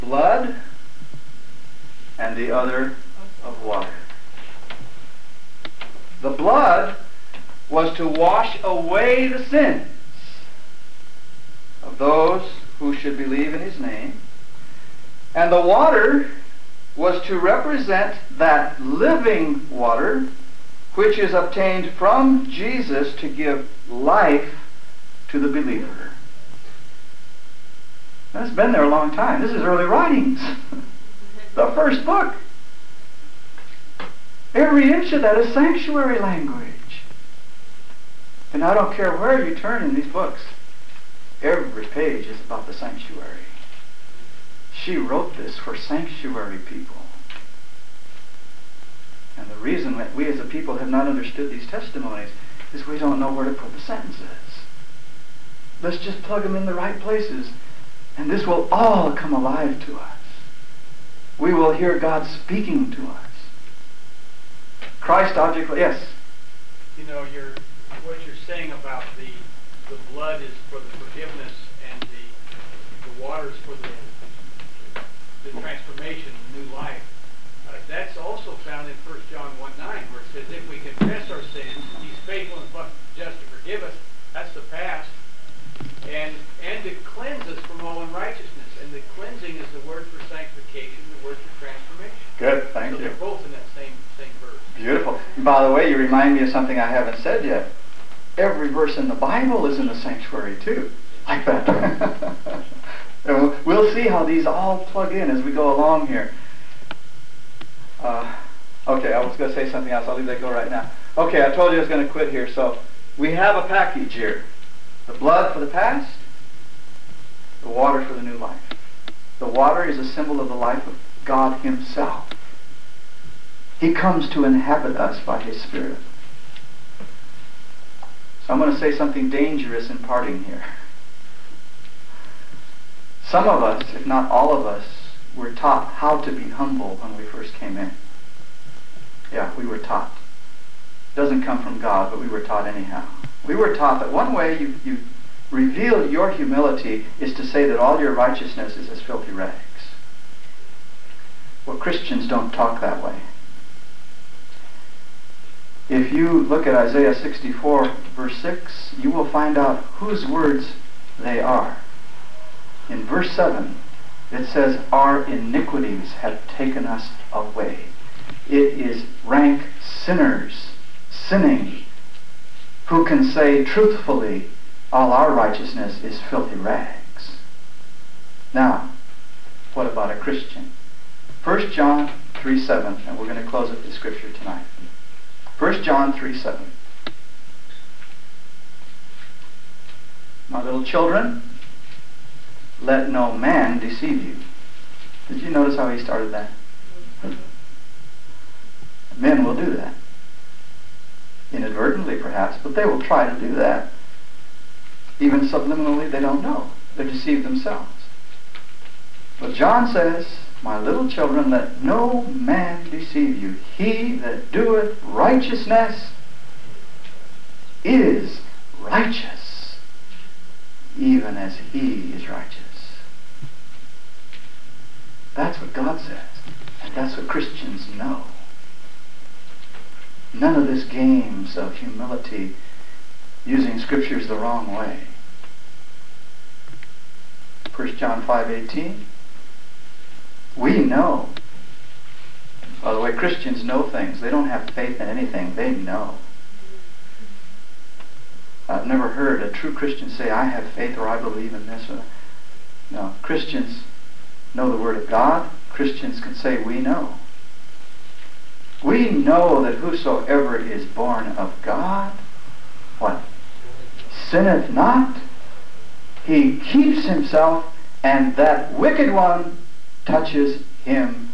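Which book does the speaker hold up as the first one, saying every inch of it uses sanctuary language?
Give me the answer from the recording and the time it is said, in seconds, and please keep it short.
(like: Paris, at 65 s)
Early Writings, at 29 s.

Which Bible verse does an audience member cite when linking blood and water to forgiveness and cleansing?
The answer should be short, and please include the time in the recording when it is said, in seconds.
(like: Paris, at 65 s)
1 John 1:9, at 79 s.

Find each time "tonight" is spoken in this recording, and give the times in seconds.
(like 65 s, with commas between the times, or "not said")
184 s.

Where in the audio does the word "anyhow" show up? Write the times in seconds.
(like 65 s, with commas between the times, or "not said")
142 s.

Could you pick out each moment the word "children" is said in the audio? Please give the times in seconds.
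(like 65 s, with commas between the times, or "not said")
190 s, 211 s.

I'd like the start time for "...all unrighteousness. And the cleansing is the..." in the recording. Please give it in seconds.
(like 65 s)
87 s.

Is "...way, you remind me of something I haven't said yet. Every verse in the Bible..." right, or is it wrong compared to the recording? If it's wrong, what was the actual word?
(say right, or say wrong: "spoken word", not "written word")
right.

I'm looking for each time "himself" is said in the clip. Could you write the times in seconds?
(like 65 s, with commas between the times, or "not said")
121 s, 267 s.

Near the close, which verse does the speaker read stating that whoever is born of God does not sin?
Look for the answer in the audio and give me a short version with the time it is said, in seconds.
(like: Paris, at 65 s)
1 John 5:18, at 237 s.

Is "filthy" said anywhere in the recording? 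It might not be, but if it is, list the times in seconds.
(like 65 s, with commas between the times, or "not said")
148 s, 176 s.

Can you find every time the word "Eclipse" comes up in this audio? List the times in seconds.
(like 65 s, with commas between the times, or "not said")
not said.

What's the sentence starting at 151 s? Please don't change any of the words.
Well, Christians don't talk that way.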